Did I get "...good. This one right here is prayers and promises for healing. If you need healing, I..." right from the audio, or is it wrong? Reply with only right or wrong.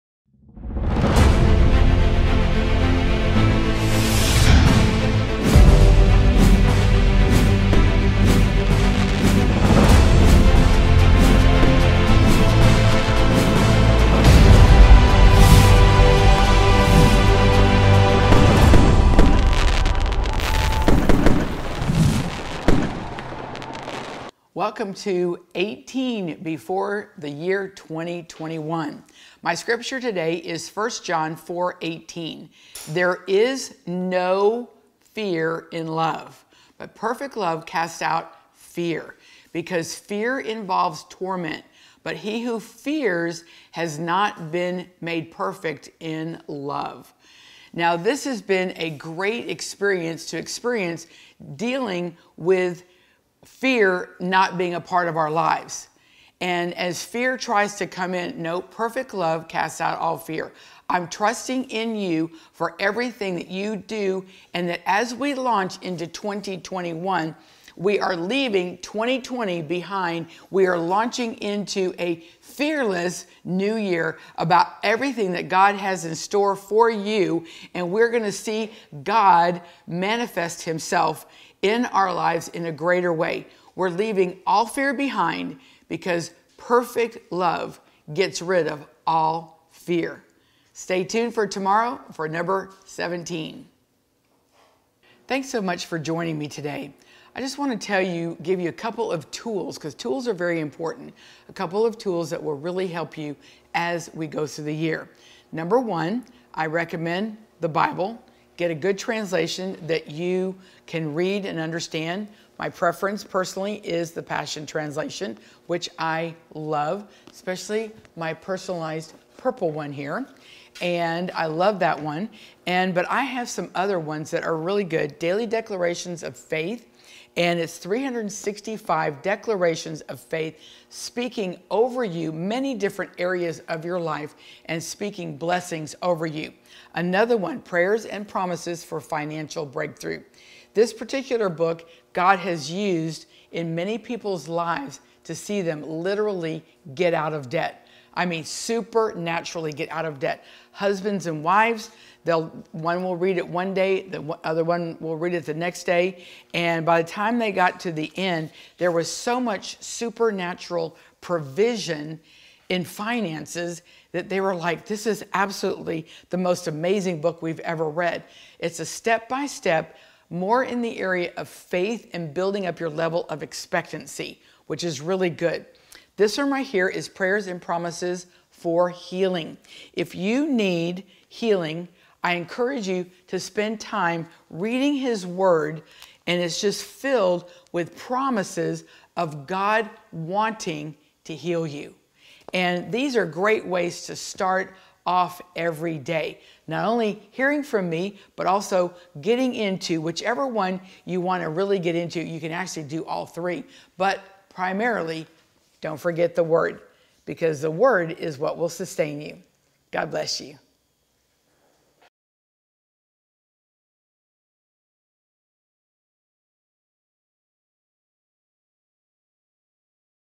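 right.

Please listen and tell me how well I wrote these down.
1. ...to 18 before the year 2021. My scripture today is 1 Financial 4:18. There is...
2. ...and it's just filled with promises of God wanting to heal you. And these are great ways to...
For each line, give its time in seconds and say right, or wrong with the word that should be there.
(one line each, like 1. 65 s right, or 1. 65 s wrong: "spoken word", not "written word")
1. 24 s wrong: "John", not "Financial"
2. 186 s right.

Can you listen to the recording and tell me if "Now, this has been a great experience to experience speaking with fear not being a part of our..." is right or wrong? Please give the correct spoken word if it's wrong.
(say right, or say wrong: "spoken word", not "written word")
wrong: "dealing", not "speaking".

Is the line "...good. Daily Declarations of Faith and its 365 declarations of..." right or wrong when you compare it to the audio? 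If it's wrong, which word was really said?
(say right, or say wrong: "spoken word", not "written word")
right.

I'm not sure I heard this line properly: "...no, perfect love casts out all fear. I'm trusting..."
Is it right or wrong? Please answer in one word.
right.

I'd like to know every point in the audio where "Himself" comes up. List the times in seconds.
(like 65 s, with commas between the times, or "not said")
80 s.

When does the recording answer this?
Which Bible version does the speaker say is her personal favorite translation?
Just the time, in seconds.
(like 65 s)
114 s.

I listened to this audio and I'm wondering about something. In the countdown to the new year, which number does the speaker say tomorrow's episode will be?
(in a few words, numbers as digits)
17.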